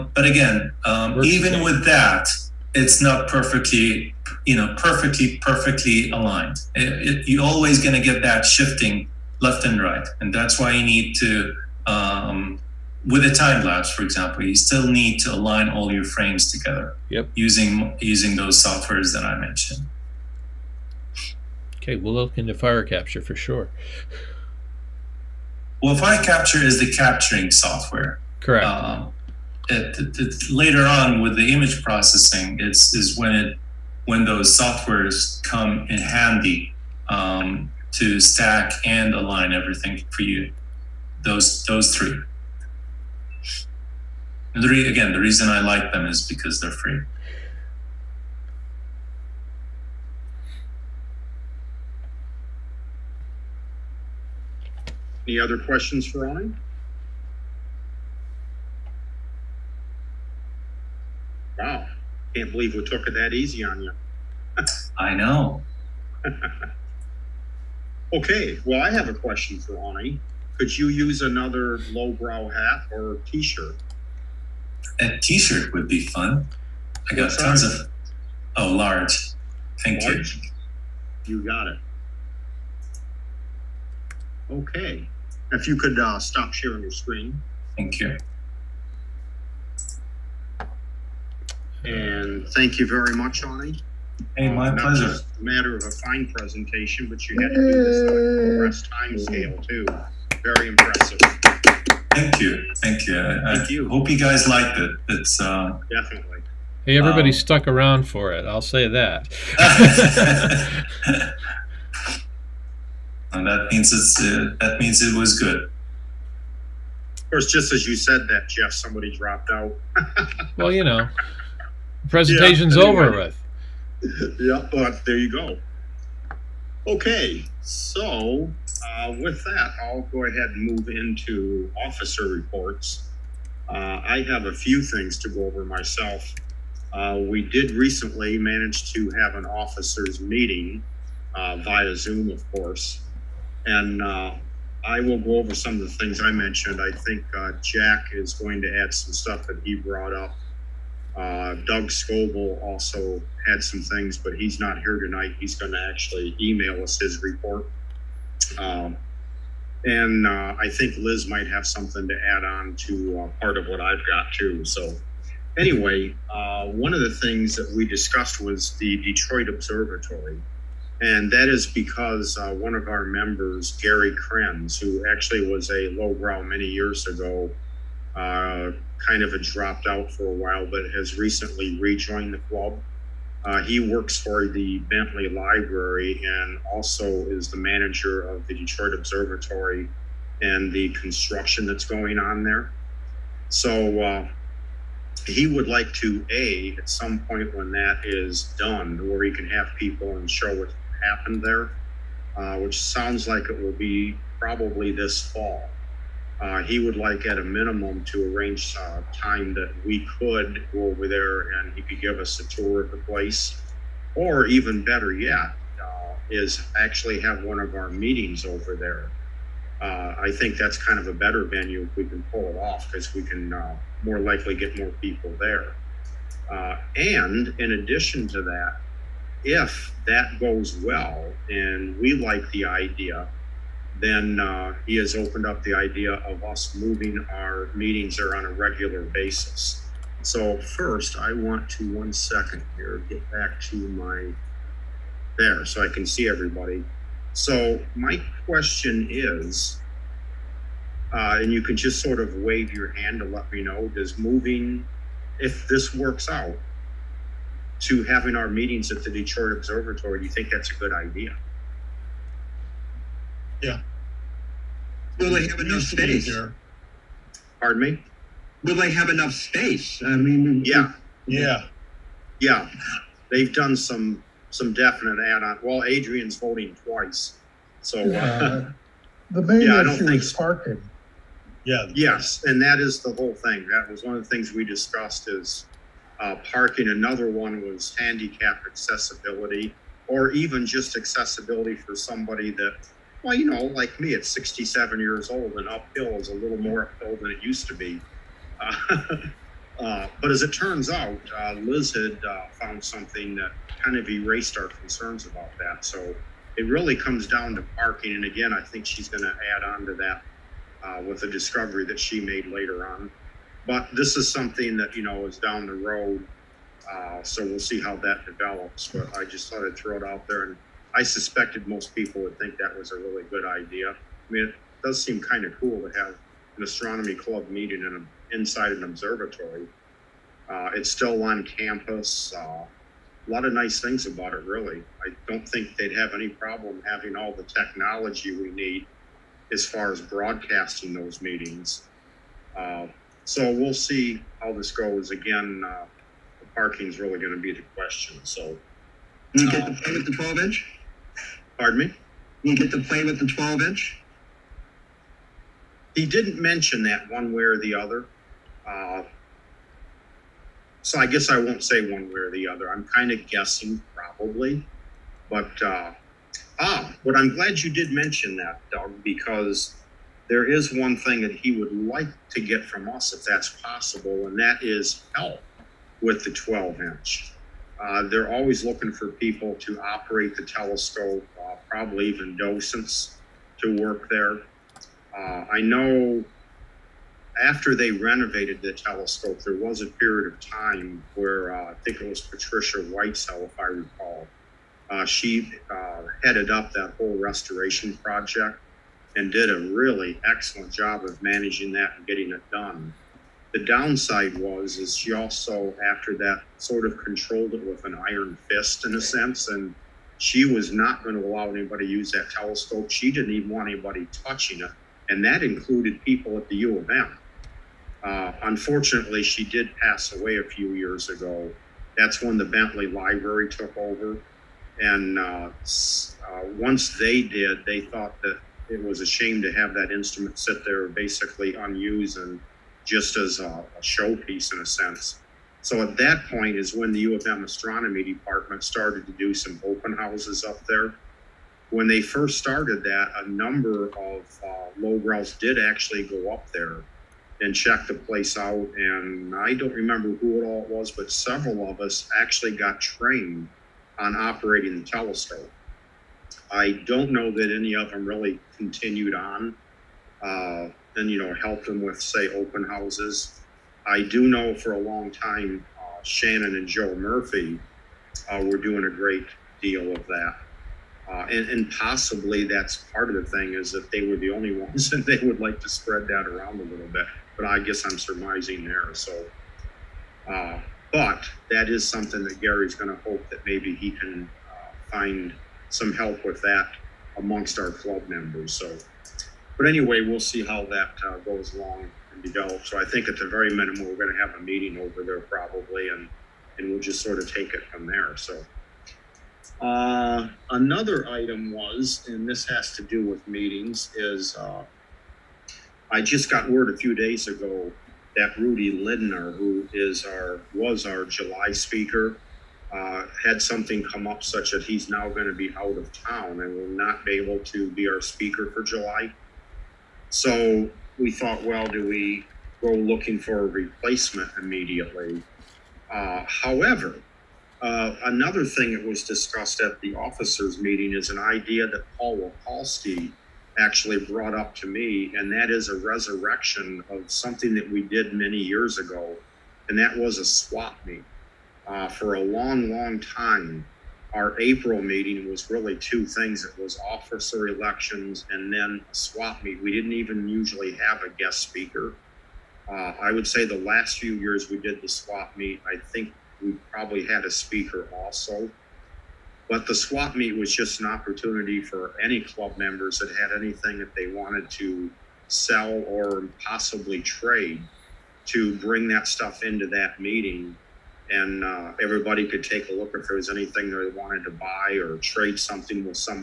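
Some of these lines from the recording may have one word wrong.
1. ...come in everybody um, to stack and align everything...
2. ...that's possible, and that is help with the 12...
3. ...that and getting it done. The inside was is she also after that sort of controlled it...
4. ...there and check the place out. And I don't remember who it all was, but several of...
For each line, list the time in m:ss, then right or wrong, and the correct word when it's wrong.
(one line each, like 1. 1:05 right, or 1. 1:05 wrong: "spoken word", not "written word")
1. 0:35 wrong: "handy", not "everybody"
2. 6:13 right
3. 6:41 wrong: "downside", not "inside"
4. 7:26 right.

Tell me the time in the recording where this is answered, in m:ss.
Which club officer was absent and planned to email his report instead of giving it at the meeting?
2:31.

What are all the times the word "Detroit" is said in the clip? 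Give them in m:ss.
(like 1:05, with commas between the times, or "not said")
2:48, 3:08, 4:19.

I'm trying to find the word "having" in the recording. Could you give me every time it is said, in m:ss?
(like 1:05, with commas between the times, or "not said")
4:18, 5:36.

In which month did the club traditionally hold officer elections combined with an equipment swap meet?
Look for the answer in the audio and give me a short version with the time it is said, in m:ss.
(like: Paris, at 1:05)
April, at 9:04.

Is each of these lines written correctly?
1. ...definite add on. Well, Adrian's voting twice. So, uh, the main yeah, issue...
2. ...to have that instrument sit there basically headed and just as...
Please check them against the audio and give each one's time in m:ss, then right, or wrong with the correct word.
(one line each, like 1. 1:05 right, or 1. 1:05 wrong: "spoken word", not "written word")
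1. 4:34 right
2. 7:09 wrong: "unused", not "headed".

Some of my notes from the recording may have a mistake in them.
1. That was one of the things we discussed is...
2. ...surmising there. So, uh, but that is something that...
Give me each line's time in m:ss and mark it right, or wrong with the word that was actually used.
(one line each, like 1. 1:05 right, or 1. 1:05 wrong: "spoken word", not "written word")
1. 4:43 right
2. 7:57 right.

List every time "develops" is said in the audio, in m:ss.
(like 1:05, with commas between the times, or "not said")
5:18, 8:12.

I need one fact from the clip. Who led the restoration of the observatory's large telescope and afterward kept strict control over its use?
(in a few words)
Patricia Whitesell.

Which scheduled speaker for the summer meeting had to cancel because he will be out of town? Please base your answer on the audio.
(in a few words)
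Rudy Lindner.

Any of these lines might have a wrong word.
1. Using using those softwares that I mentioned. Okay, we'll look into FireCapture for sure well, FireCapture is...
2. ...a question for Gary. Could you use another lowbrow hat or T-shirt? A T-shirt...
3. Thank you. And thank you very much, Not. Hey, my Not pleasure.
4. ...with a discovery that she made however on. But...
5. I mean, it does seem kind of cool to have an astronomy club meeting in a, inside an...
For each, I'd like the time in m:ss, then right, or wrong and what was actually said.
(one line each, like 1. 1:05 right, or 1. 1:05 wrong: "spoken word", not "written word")
1. 0:17 right
2. 1:09 wrong: "Ronnie", not "Gary"
3. 1:27 wrong: "Awni", not "Not"
4. 5:11 wrong: "later", not "however"
5. 5:23 right.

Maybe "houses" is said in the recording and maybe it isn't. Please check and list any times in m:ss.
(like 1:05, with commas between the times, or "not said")
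7:19, 7:42.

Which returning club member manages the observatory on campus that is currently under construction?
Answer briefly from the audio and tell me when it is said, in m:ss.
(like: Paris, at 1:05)
Gary Krenz, at 2:53.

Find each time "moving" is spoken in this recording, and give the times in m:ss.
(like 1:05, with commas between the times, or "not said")
3:56, 4:14.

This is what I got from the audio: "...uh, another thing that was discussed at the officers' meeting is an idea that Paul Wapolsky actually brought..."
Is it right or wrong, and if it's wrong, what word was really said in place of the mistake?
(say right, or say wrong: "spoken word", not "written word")
right.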